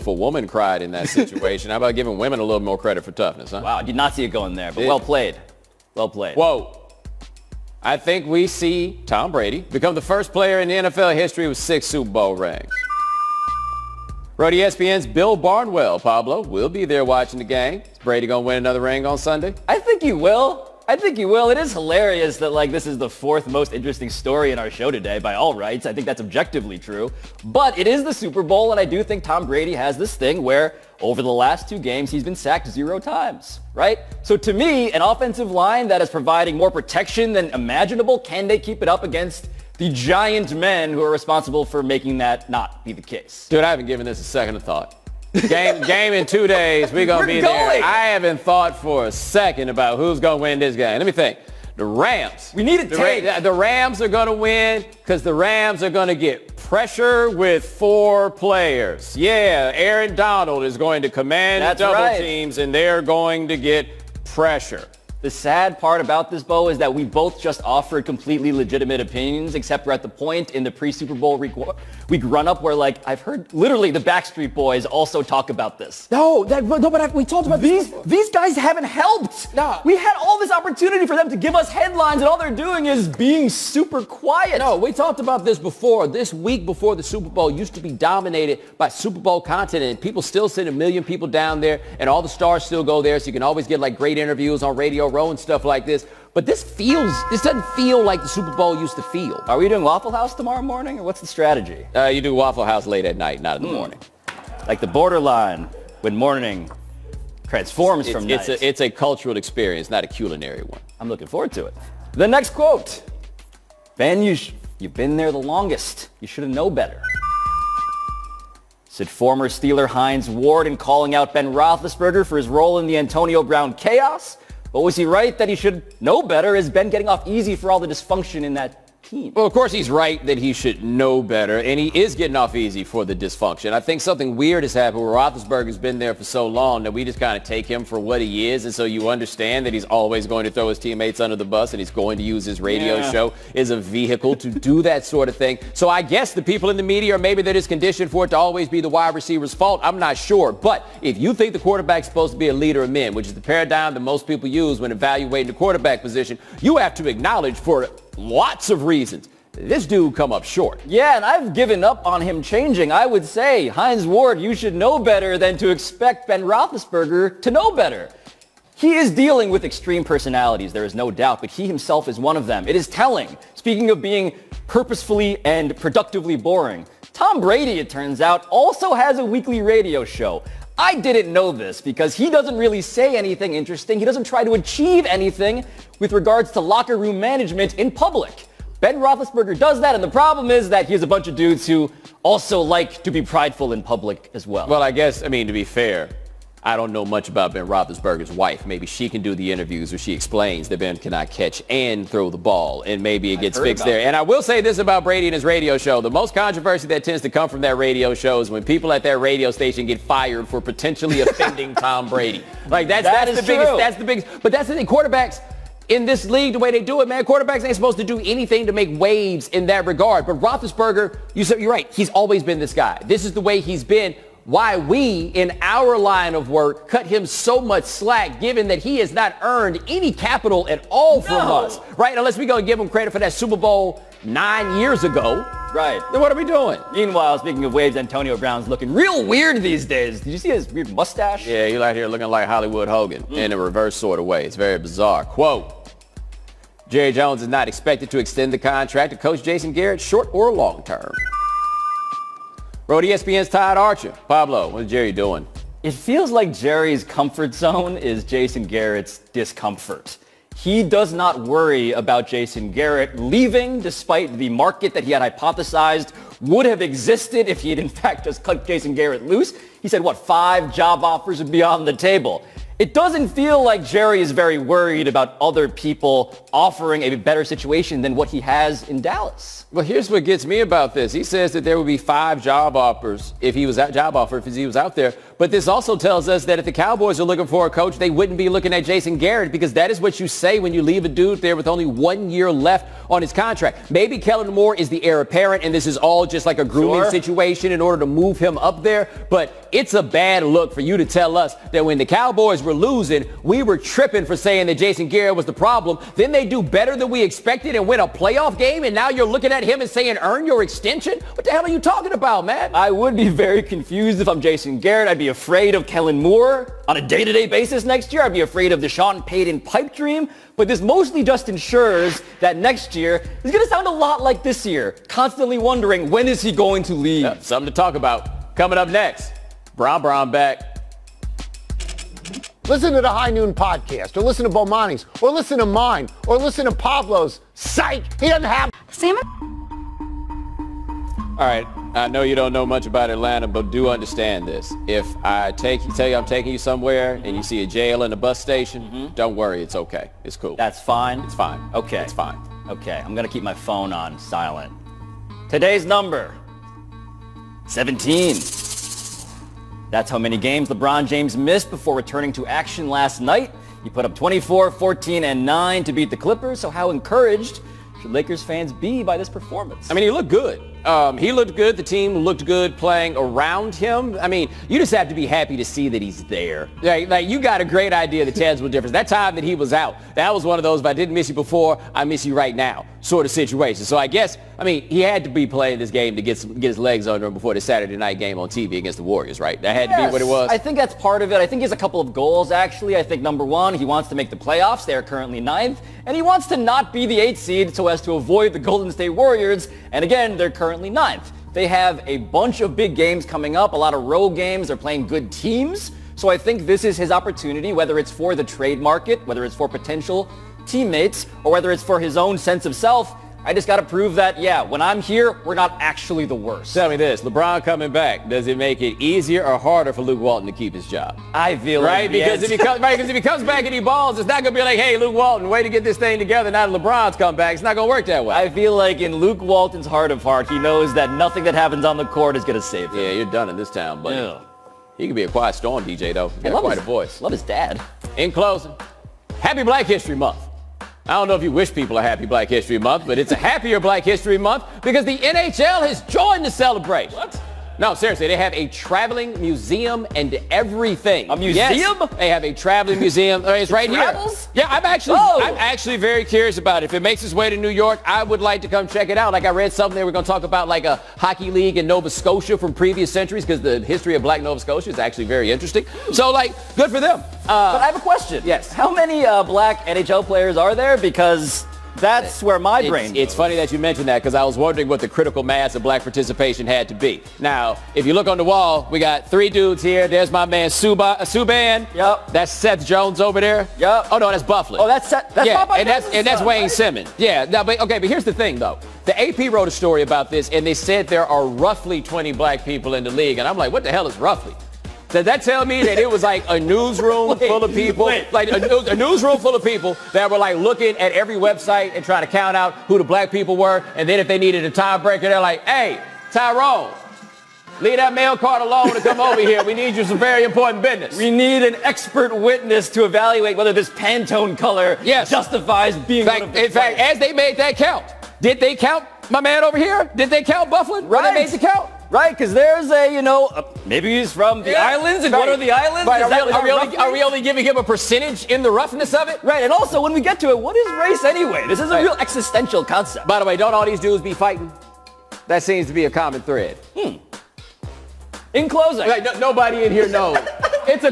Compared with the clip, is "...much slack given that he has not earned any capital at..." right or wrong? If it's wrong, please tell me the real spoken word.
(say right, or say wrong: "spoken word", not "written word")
right.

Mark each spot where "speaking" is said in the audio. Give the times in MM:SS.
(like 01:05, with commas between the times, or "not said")
02:53, 03:57.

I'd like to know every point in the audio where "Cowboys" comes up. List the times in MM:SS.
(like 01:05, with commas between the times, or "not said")
04:46, 05:02.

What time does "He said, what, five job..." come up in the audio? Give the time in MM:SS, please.
04:29.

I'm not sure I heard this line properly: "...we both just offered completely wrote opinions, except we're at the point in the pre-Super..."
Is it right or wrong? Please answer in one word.
wrong.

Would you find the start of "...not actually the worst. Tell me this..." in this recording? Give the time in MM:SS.
06:55.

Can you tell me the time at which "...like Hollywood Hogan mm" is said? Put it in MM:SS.
04:02.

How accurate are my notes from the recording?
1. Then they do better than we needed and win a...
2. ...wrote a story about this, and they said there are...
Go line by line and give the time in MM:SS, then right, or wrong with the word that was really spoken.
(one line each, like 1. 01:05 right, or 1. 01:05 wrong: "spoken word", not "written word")
1. 05:06 wrong: "expected", not "needed"
2. 08:09 right.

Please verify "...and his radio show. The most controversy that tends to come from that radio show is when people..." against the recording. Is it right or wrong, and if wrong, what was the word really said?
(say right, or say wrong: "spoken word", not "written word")
right.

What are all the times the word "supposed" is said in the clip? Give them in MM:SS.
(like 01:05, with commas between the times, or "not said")
02:32, 03:37.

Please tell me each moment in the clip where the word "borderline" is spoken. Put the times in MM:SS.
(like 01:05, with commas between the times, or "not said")
01:44.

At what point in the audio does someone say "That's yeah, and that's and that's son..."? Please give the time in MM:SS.
08:05.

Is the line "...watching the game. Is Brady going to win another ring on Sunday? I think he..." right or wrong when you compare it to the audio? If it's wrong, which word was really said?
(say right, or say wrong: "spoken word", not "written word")
right.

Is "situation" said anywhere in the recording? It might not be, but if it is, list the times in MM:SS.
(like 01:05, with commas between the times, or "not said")
00:01, 04:37, 04:57, 06:23.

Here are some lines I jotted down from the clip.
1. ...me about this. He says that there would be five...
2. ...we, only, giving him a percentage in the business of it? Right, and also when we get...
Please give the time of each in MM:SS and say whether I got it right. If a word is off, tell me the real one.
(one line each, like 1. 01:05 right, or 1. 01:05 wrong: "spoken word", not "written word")
1. 04:40 right
2. 08:47 wrong: "roughness", not "business".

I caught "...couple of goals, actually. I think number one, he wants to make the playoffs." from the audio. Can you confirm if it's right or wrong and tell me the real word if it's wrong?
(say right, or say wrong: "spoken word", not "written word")
right.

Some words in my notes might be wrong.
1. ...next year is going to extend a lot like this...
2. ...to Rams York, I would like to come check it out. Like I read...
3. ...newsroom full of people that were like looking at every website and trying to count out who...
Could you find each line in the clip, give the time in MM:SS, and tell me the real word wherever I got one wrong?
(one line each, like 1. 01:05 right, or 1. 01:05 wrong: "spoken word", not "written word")
1. 05:22 wrong: "sound", not "extend"
2. 07:37 wrong: "New", not "Rams"
3. 08:18 right.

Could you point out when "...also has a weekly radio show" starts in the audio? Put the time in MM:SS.
02:58.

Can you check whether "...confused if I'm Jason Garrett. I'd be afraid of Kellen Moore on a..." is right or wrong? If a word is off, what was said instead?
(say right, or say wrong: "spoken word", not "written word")
right.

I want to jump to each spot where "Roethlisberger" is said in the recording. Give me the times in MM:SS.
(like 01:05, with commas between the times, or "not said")
02:01, 02:15, 02:46, 03:08, 03:17, 03:40.